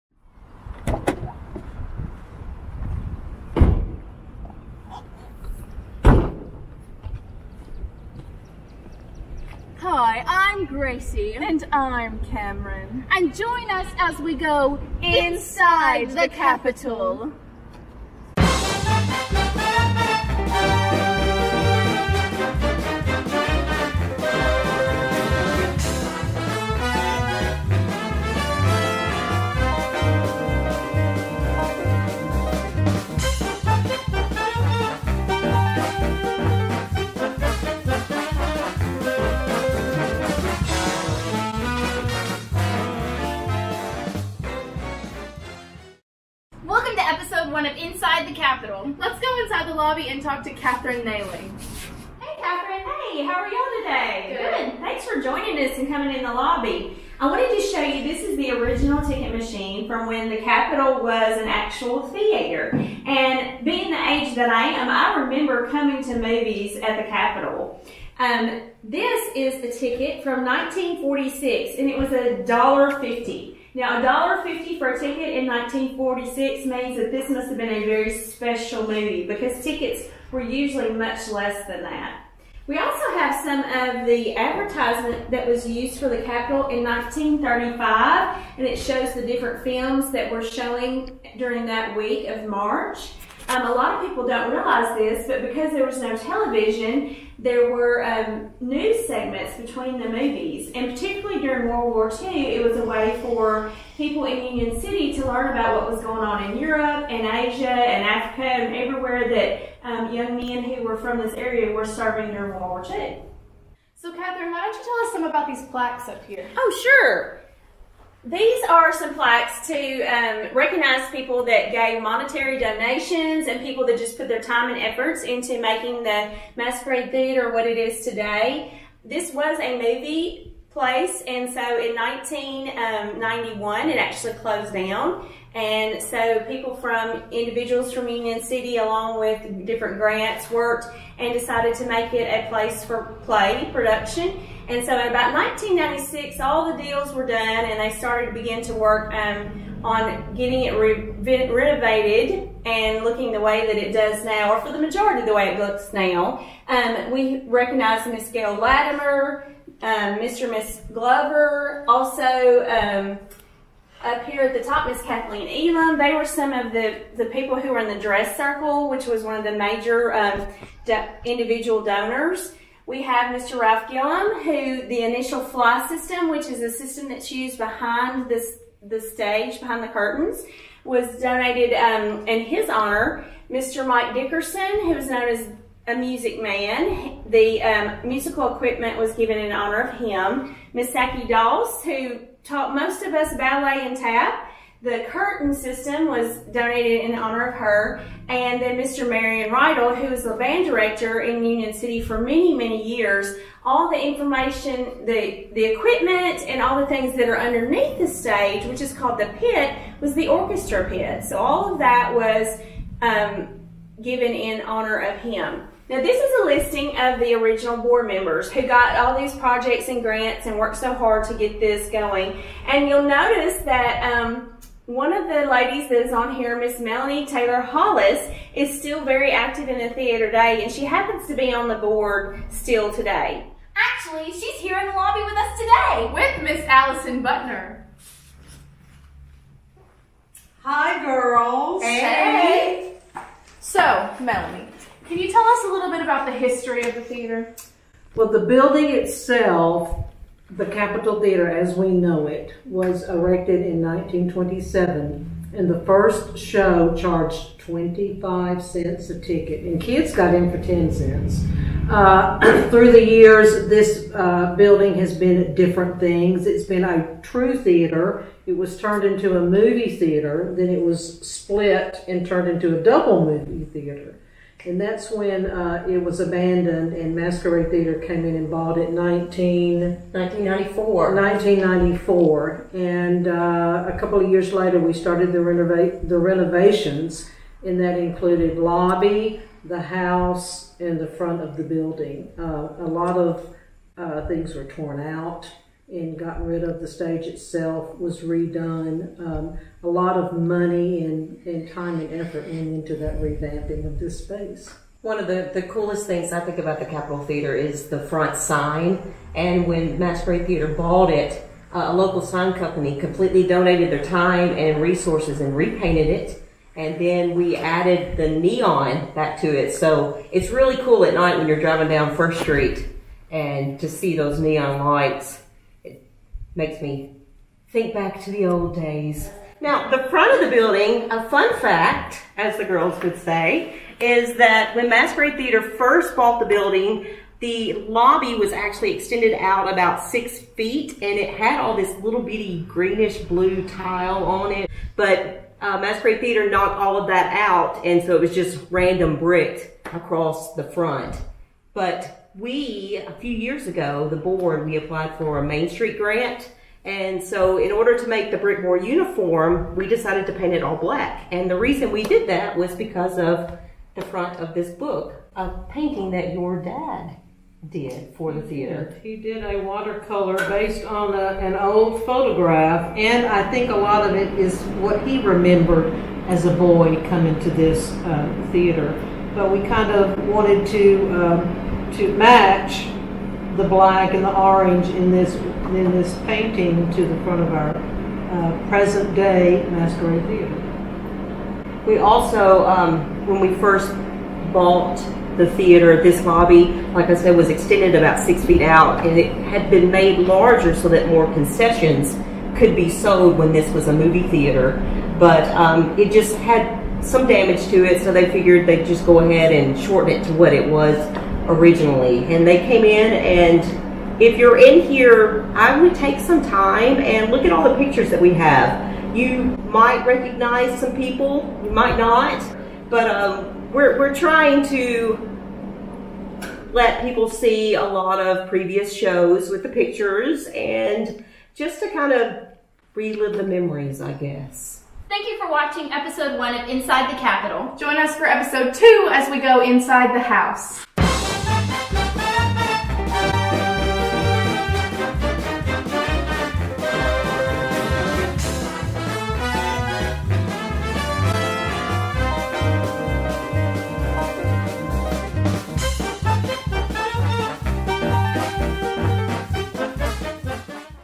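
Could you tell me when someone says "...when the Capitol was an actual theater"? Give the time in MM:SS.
01:00.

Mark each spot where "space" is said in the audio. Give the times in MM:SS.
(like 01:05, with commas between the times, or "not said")
05:04.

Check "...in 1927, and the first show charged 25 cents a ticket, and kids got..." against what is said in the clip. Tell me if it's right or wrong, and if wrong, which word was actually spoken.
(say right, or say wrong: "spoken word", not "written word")
right.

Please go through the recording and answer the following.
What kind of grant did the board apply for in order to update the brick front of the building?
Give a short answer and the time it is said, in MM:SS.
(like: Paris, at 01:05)
Main Street grant, at 05:55.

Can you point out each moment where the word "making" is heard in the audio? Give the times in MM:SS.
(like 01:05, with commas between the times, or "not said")
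02:05.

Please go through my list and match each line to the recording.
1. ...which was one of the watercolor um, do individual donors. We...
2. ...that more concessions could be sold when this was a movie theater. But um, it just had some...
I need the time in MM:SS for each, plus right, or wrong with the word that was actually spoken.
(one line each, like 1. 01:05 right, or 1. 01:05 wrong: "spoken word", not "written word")
1. 02:48 wrong: "major", not "watercolor"
2. 06:40 right.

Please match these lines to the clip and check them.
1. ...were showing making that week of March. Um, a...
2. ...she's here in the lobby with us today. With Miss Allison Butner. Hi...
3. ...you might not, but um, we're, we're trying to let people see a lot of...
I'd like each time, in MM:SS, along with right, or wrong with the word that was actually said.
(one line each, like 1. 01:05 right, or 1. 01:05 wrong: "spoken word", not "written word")
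1. 01:30 wrong: "during", not "making"
2. 03:54 right
3. 07:01 right.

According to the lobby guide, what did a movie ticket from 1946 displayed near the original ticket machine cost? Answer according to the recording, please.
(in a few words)
$1.50.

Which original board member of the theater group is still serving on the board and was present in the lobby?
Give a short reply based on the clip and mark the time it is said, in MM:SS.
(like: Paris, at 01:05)
Melanie Taylor Hollis, at 03:46.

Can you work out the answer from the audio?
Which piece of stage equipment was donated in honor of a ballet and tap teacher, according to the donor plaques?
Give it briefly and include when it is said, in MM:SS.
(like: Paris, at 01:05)
The curtain system, at 03:14.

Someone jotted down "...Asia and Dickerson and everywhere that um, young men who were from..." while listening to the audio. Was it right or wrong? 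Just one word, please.
wrong.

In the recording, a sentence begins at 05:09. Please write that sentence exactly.
And when Masquerade Theater bought it, uh, a local sign company completely donated their time and resources and repainted it.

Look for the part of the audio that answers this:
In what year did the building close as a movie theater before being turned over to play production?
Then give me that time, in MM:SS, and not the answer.
02:11.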